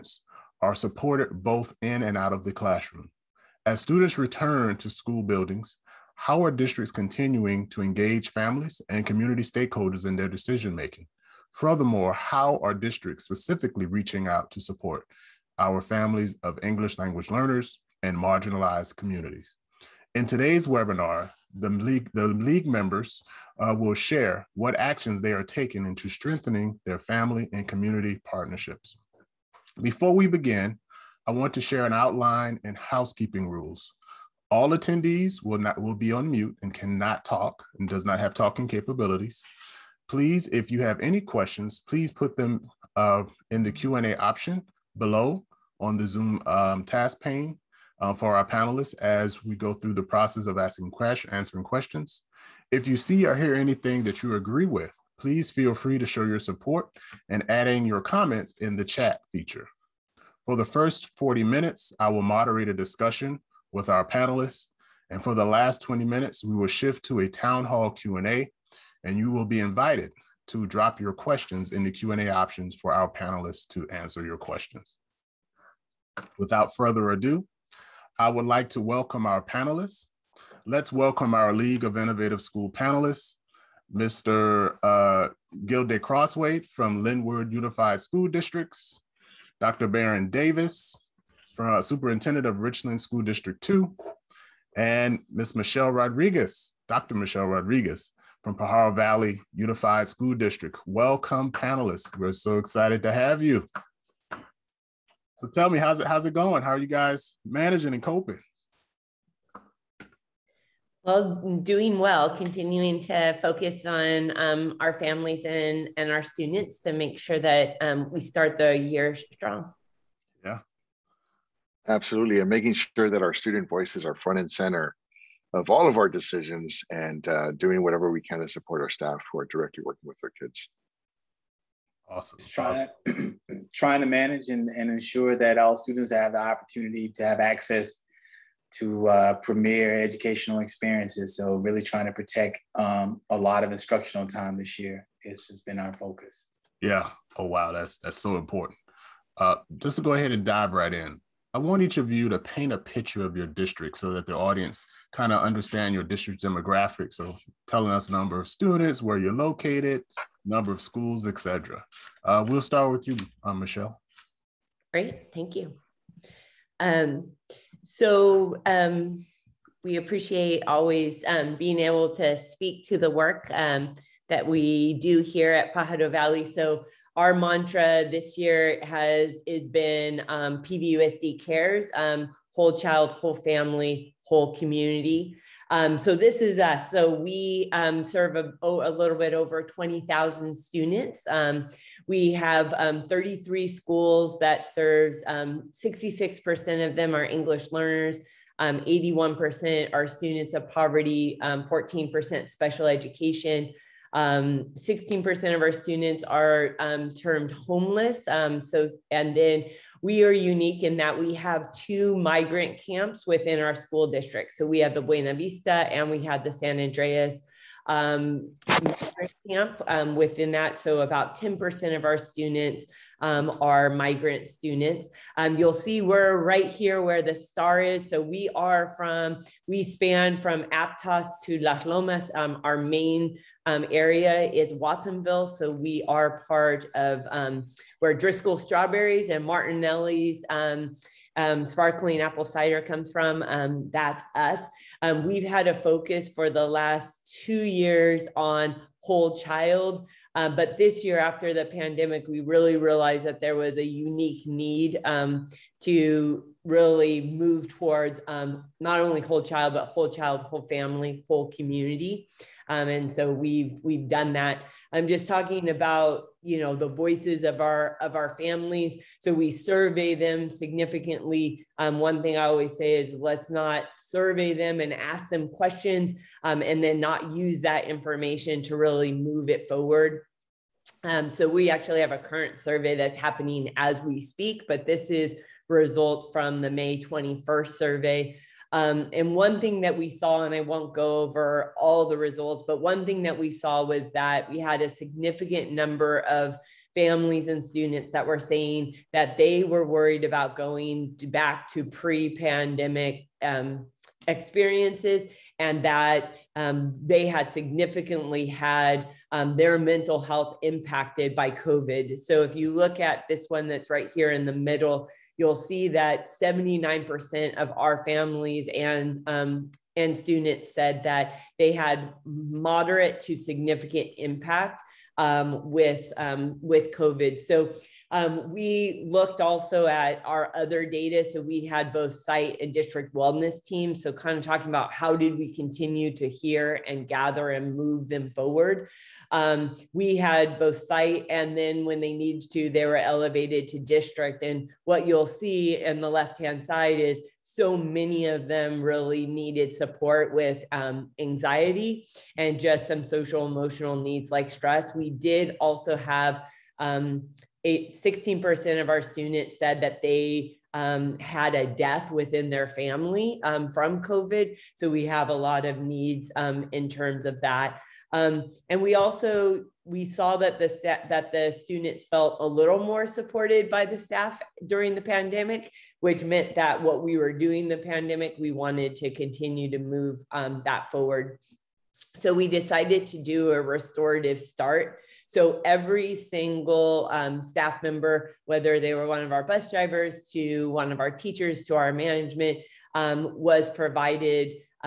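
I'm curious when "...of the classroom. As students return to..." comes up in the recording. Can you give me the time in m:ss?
0:02.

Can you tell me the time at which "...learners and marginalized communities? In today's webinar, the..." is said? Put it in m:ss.
0:17.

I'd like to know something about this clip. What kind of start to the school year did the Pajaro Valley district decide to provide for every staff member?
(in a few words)
restorative start.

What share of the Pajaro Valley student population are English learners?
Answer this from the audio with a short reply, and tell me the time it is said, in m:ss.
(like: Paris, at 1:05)
66%, at 3:15.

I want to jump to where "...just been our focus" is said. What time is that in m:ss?
2:25.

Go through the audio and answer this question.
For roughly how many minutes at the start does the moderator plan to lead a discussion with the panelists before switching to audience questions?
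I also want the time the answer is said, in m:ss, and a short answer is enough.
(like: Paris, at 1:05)
40, at 1:01.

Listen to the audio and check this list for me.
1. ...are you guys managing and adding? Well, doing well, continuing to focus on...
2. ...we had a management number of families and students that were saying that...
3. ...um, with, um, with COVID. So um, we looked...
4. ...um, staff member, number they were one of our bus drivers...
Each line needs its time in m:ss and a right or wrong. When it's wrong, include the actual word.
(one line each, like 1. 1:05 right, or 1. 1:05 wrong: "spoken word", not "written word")
1. 1:46 wrong: "coping", not "adding"
2. 4:54 wrong: "significant", not "management"
3. 5:25 right
4. 6:27 wrong: "whether", not "number".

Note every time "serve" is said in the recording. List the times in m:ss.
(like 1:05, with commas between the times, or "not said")
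3:08, 3:14.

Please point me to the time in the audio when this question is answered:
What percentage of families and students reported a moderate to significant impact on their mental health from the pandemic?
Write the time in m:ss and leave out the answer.
5:16.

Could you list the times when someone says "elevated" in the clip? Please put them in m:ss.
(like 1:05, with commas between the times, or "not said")
5:42.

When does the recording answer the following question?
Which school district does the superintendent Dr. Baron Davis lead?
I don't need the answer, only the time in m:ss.
1:32.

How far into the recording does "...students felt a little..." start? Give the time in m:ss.
6:11.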